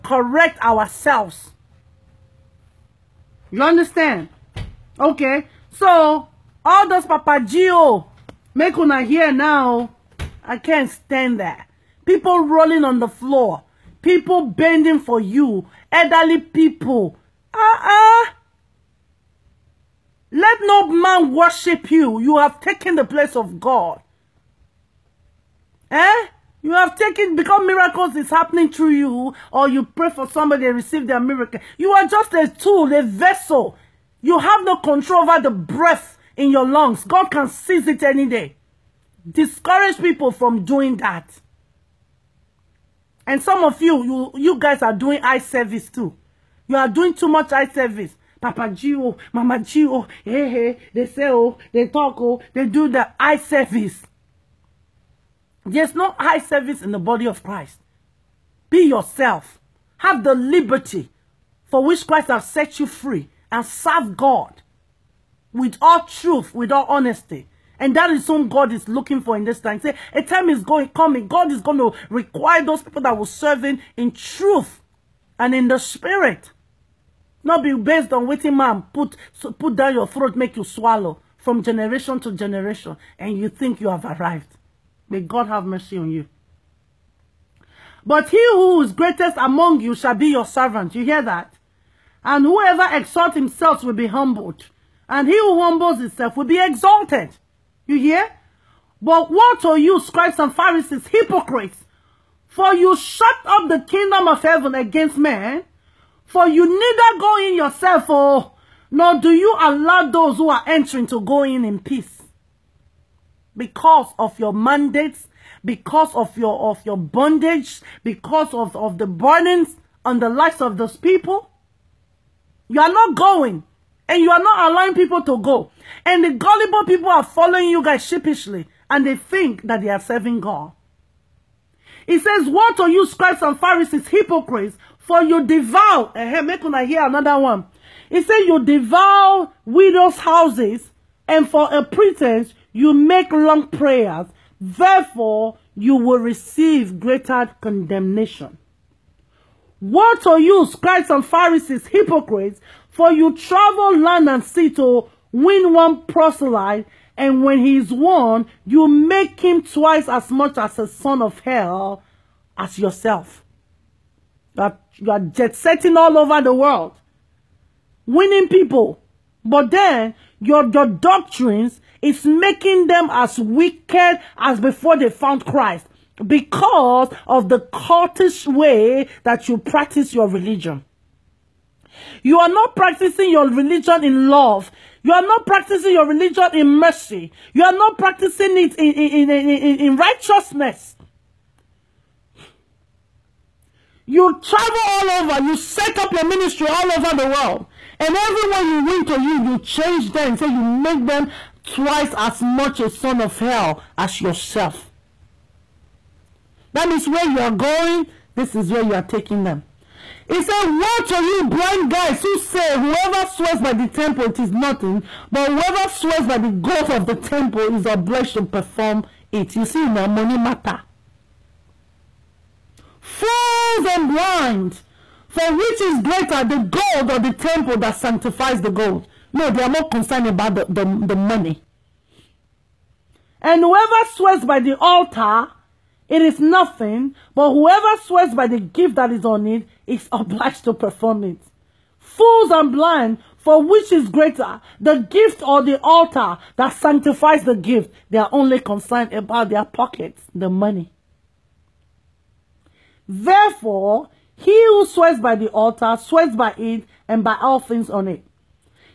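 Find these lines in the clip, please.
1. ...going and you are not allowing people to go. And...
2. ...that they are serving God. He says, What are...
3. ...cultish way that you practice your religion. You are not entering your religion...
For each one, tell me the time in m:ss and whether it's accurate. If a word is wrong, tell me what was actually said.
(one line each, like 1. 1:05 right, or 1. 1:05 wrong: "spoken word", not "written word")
1. 2:03 right
2. 2:09 right
3. 2:57 wrong: "practicing", not "entering".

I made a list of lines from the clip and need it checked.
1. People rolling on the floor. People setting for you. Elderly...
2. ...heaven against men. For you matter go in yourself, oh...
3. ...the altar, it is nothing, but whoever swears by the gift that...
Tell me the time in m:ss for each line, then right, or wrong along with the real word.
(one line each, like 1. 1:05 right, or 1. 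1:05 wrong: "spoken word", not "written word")
1. 0:12 wrong: "bending", not "setting"
2. 1:44 wrong: "neither", not "matter"
3. 3:54 right.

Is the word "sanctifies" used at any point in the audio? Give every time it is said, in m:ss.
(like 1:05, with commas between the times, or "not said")
3:47, 4:06.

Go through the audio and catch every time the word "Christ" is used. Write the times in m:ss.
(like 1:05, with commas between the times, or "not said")
0:57, 1:02, 2:55.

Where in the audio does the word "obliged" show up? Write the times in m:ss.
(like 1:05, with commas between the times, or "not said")
3:37, 4:00.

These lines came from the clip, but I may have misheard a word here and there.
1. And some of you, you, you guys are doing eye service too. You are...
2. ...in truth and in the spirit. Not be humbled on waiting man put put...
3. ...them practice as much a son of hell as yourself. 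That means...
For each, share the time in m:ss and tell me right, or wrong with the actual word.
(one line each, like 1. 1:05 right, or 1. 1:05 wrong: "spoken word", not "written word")
1. 0:43 right
2. 1:13 wrong: "based", not "humbled"
3. 3:21 wrong: "twice", not "practice".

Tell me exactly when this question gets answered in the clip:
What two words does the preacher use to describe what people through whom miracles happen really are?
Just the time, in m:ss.
0:32.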